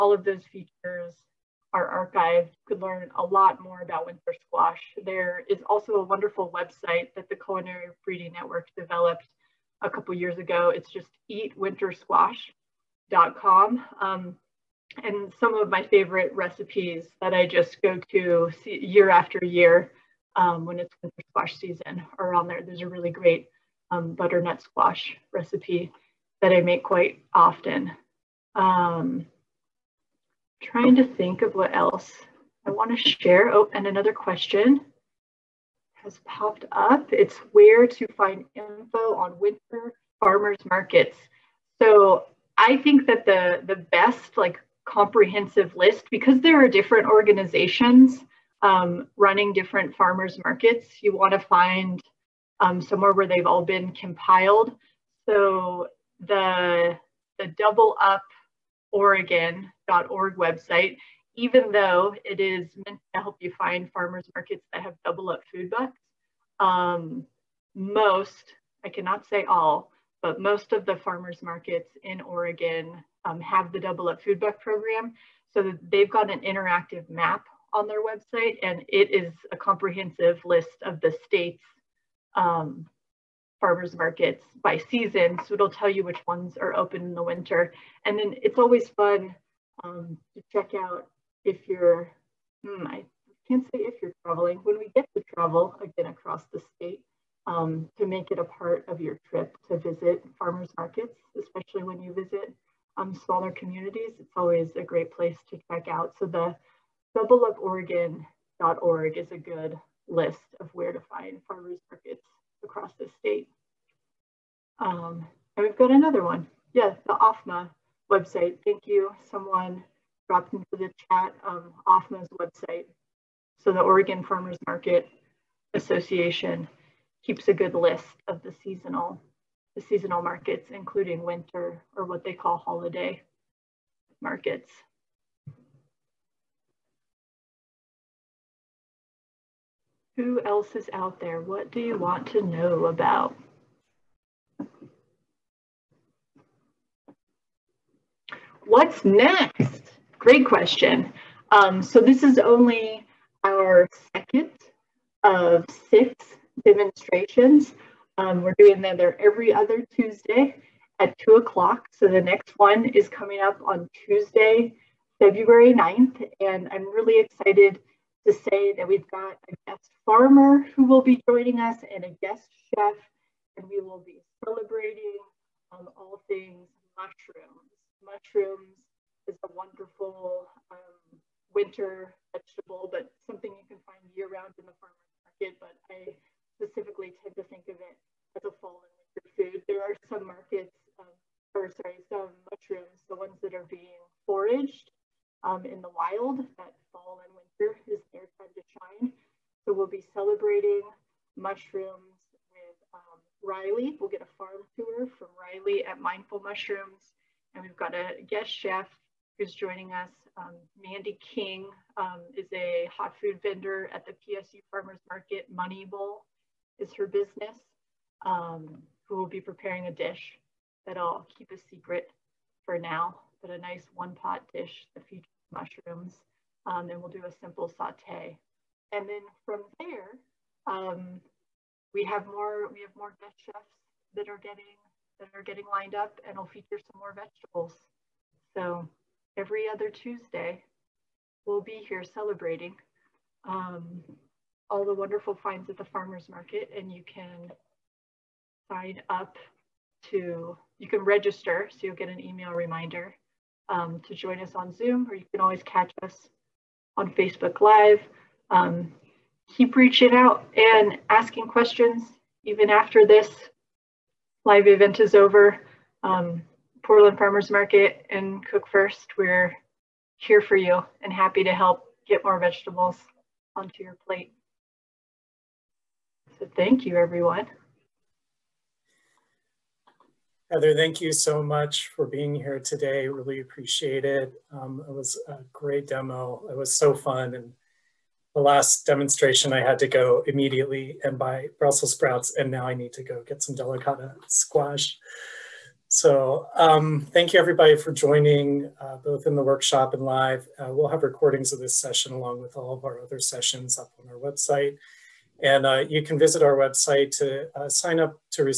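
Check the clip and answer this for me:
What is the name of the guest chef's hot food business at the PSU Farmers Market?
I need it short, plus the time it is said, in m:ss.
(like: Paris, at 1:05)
Money Bowl, at 3:35.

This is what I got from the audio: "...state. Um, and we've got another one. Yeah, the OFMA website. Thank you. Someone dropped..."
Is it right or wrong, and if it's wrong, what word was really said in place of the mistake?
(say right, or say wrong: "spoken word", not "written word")
right.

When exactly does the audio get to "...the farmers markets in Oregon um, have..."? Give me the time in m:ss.
1:10.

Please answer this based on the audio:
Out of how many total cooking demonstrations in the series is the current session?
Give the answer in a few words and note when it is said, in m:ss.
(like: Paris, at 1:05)
6, at 2:35.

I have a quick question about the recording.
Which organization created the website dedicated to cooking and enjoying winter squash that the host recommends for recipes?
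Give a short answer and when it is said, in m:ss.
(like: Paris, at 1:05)
Culinary Breeding Network, at 0:07.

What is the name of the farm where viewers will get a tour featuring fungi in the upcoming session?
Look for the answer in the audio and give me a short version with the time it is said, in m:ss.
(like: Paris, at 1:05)
Mindful Mushrooms, at 3:25.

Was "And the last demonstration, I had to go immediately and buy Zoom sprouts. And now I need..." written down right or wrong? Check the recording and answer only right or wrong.
wrong.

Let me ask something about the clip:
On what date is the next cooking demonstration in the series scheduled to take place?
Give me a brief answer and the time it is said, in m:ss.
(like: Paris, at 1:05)
February 9th, at 2:45.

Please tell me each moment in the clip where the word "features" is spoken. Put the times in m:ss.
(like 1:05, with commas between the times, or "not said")
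0:00, 3:45, 3:56.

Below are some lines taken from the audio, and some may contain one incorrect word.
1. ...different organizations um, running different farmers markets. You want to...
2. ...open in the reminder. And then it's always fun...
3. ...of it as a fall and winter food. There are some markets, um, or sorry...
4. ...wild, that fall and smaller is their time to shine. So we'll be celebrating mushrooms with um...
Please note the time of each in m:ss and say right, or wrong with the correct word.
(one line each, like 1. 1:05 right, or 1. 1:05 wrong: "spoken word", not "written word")
1. 0:46 right
2. 1:26 wrong: "winter", not "reminder"
3. 3:07 right
4. 3:15 wrong: "winter", not "smaller".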